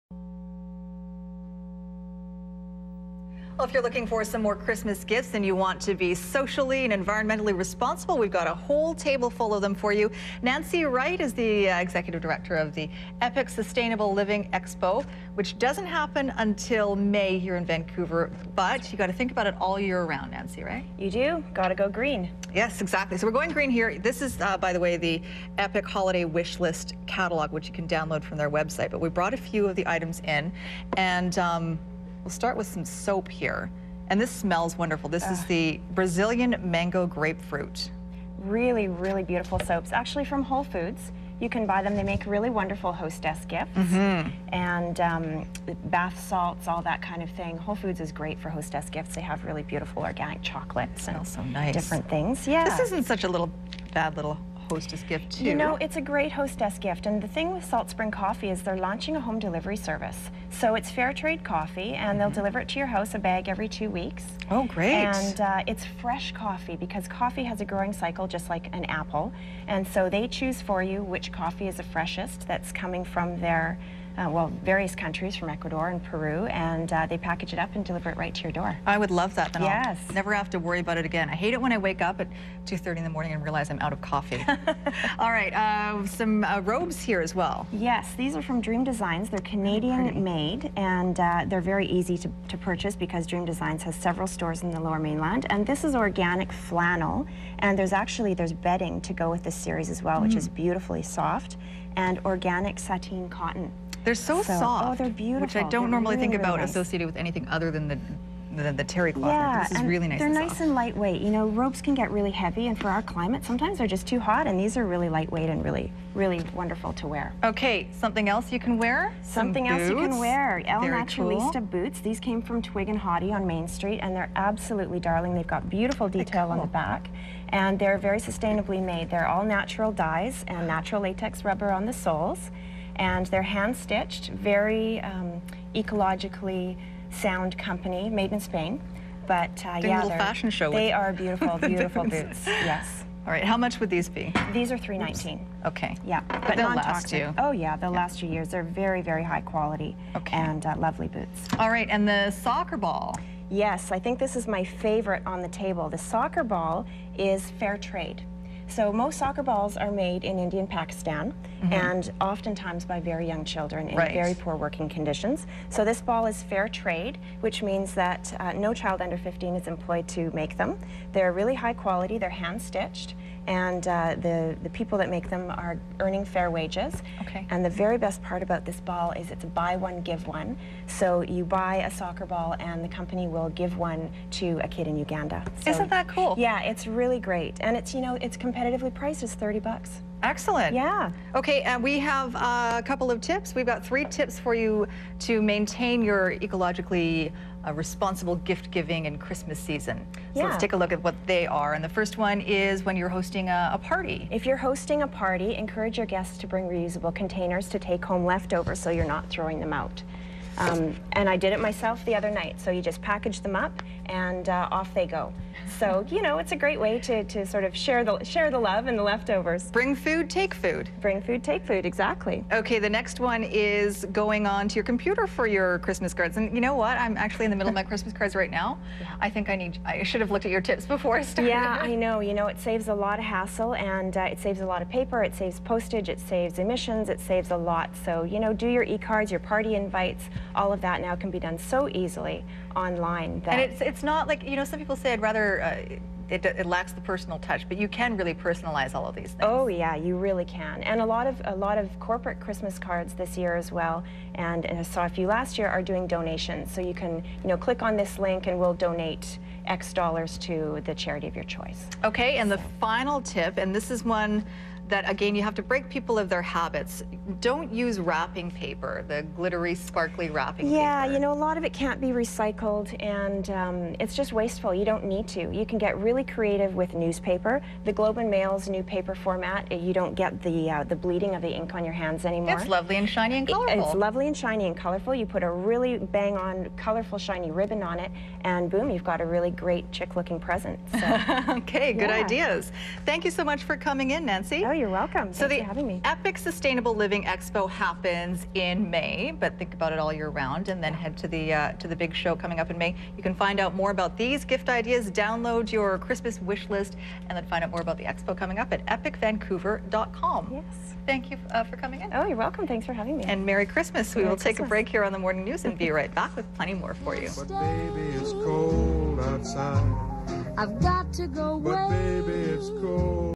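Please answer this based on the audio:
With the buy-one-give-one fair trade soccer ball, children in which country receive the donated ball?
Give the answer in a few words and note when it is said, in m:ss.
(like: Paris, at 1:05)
Uganda, at 3:04.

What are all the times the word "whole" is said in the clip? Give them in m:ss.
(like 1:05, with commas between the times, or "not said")
0:08, 0:40, 0:47.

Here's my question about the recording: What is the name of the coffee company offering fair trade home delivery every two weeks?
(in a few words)
Salt Spring Coffee.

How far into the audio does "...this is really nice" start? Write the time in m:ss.
1:49.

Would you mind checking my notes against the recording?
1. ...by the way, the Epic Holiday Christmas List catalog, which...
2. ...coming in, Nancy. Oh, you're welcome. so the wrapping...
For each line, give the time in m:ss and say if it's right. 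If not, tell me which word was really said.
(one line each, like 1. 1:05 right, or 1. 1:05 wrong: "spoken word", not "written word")
1. 0:24 wrong: "Wish", not "Christmas"
2. 4:53 wrong: "having", not "wrapping".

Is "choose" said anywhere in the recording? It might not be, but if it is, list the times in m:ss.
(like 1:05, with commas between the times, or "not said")
1:10.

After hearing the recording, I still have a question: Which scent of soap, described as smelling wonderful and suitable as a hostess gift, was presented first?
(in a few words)
Brazilian mango grapefruit.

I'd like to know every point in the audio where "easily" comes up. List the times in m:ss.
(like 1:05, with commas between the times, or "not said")
4:01.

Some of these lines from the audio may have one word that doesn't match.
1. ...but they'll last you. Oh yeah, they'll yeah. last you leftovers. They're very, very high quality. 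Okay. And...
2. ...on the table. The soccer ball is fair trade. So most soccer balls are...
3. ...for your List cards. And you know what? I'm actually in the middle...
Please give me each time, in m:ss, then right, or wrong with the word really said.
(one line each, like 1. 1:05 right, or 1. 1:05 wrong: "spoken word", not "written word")
1. 2:26 wrong: "years", not "leftovers"
2. 2:35 right
3. 3:45 wrong: "Christmas", not "List".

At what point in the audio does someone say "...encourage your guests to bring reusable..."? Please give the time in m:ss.
3:25.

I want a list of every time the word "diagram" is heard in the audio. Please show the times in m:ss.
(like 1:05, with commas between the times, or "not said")
not said.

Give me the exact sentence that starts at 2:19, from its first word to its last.
But uh, Doing yeah, a little fashion show.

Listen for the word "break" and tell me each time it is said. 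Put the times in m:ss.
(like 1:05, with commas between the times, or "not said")
4:25, 5:14.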